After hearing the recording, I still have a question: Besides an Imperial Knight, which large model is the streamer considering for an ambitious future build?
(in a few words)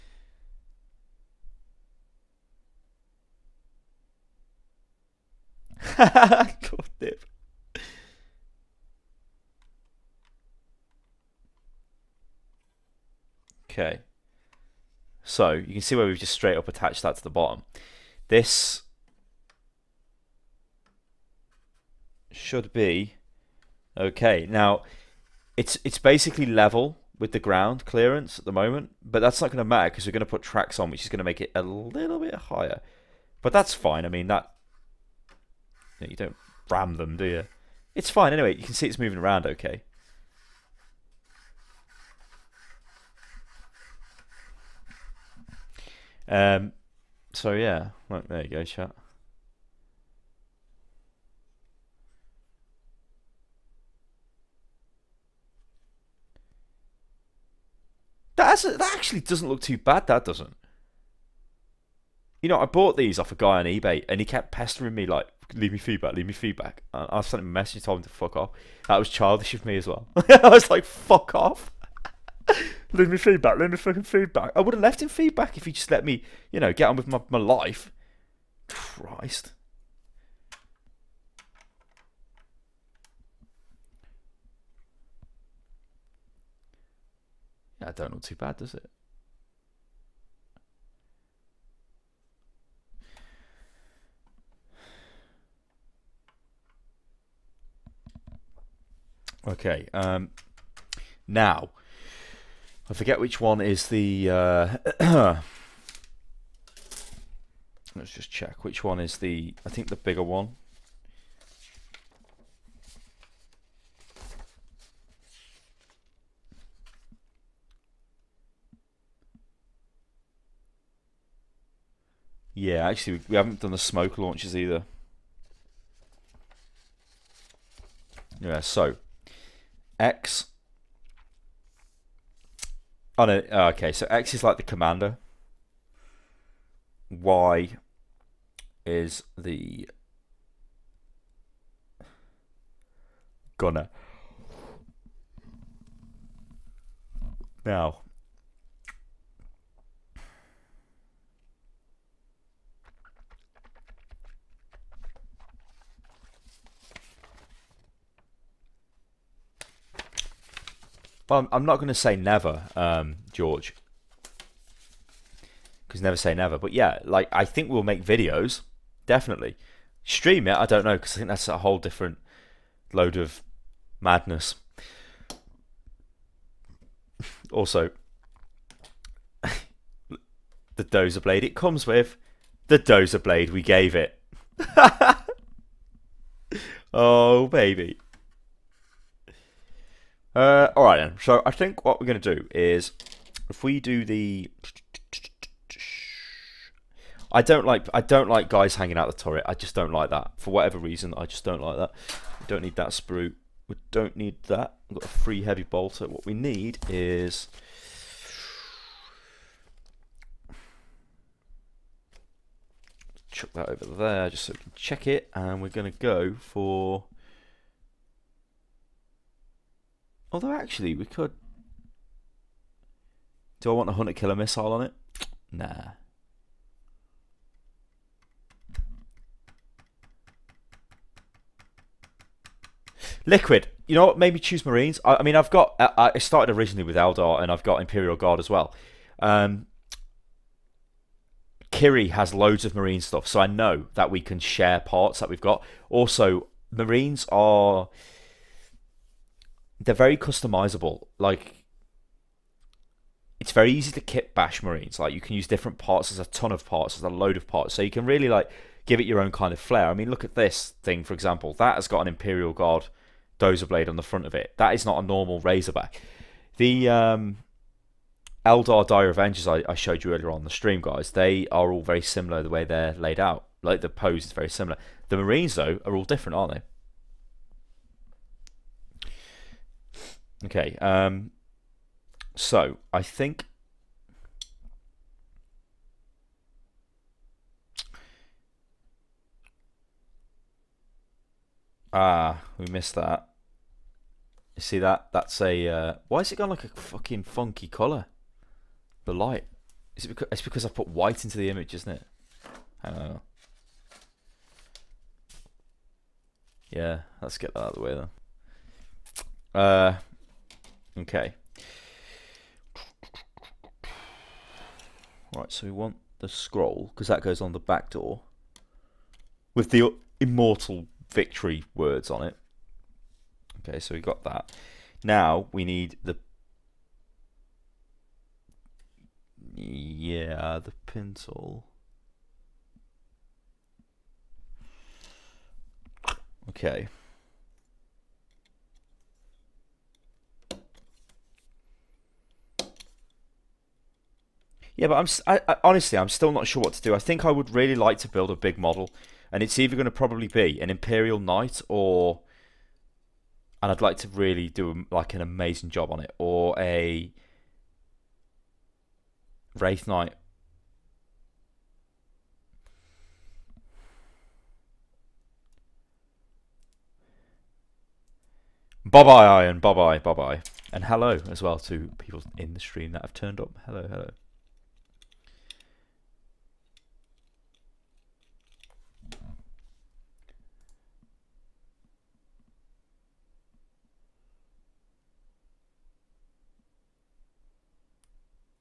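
Wraithknight.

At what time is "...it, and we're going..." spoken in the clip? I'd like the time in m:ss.
3:35.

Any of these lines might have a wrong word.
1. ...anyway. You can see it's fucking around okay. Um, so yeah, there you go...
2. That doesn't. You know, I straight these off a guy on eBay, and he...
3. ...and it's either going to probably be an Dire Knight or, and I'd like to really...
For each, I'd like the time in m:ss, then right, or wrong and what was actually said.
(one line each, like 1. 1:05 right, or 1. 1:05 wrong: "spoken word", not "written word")
1. 0:38 wrong: "moving", not "fucking"
2. 1:00 wrong: "bought", not "straight"
3. 5:49 wrong: "Imperial", not "Dire".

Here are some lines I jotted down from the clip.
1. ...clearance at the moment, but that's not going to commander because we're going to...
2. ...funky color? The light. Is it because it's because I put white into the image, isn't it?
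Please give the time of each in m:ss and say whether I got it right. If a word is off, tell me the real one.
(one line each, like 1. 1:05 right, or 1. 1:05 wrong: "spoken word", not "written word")
1. 0:27 wrong: "matter", not "commander"
2. 4:57 right.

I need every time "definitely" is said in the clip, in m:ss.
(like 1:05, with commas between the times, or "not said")
2:49.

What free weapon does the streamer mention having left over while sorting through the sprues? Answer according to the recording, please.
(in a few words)
Heavy bolter.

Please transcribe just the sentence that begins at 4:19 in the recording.
I mean, look at this thing for example.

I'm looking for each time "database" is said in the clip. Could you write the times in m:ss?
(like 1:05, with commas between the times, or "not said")
not said.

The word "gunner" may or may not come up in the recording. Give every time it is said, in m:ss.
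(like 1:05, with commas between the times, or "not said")
2:23.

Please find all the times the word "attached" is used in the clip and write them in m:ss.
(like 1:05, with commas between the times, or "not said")
0:16.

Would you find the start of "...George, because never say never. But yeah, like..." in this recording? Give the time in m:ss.
2:43.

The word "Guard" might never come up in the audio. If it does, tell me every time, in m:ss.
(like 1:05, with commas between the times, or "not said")
3:58, 4:22.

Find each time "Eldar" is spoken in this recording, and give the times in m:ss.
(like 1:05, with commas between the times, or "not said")
3:56, 4:28.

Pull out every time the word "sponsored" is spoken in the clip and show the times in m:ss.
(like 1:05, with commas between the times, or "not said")
not said.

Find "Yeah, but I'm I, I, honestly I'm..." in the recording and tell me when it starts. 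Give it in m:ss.
5:44.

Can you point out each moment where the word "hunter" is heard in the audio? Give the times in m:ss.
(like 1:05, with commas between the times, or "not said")
3:43.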